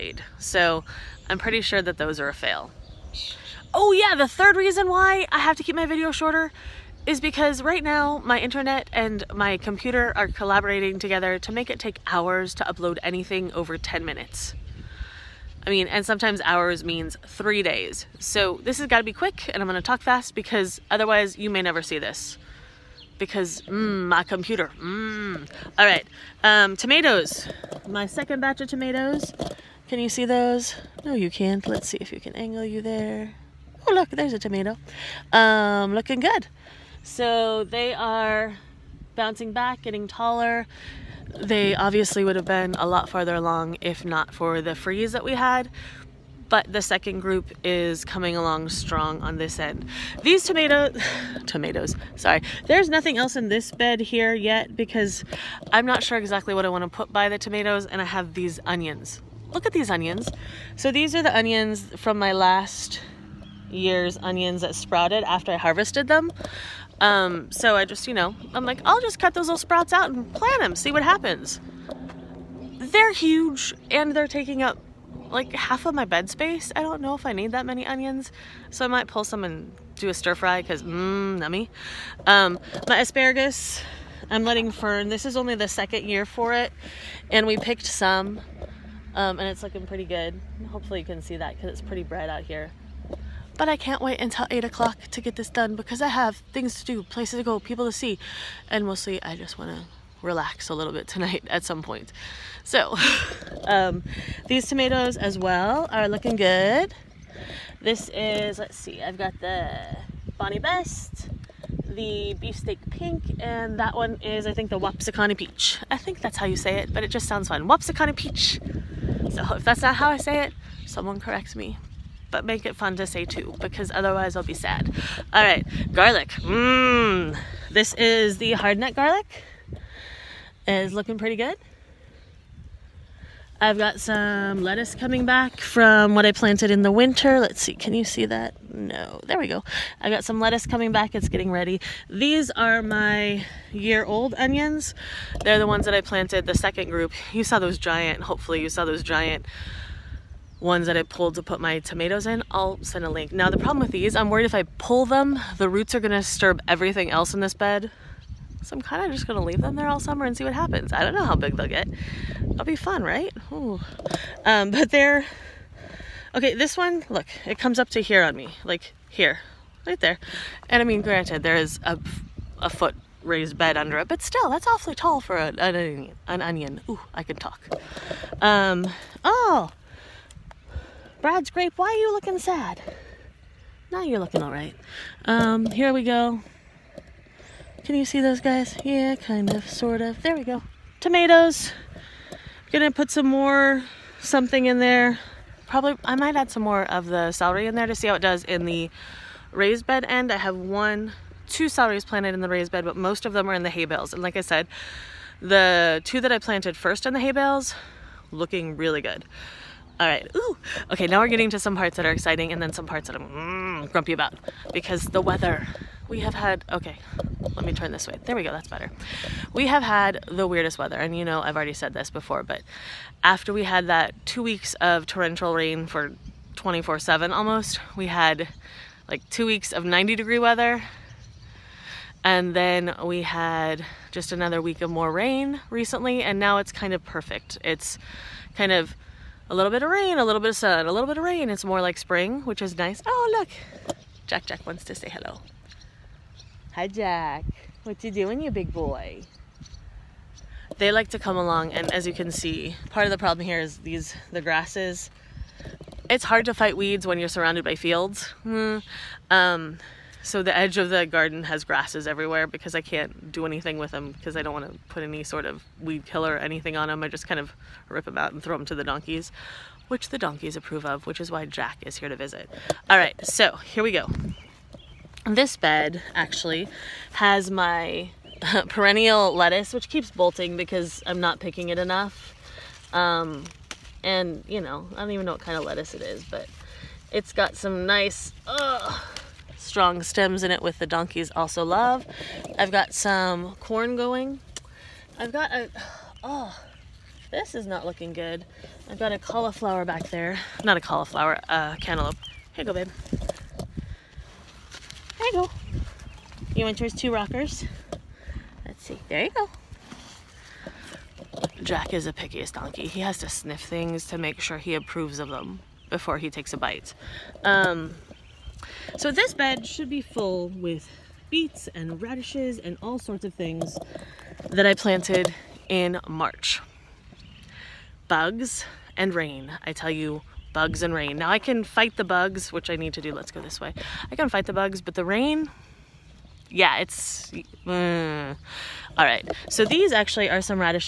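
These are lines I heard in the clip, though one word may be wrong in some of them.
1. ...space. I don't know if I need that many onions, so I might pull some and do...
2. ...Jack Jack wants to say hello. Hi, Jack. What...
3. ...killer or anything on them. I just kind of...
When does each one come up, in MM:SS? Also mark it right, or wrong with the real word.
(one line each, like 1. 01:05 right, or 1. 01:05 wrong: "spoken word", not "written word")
1. 01:16 right
2. 04:04 right
3. 04:26 right.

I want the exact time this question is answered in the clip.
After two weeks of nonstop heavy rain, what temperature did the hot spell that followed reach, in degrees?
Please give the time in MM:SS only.
03:49.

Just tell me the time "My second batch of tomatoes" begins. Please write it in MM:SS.
00:27.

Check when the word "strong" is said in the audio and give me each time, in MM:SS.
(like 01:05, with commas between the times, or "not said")
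00:48, 04:49.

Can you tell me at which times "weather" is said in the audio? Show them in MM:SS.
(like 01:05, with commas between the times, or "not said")
03:35, 03:40, 03:50.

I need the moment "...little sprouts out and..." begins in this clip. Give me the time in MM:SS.
01:09.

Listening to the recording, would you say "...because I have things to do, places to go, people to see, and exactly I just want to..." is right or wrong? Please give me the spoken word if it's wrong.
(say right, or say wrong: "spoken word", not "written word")
wrong: "mostly", not "exactly".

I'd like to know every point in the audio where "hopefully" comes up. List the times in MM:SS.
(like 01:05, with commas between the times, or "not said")
01:30, 02:28.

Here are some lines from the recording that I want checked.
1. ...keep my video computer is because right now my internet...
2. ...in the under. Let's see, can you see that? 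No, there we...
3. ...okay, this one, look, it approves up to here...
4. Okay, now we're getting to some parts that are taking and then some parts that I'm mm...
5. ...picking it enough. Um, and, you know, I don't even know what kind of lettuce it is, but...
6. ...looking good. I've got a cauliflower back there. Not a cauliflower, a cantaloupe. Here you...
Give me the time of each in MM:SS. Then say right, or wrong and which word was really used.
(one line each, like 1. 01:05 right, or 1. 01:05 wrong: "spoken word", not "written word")
1. 00:05 wrong: "shorter", not "computer"
2. 02:16 wrong: "winter", not "under"
3. 02:46 wrong: "comes", not "approves"
4. 03:30 wrong: "exciting", not "taking"
5. 04:41 right
6. 04:57 right.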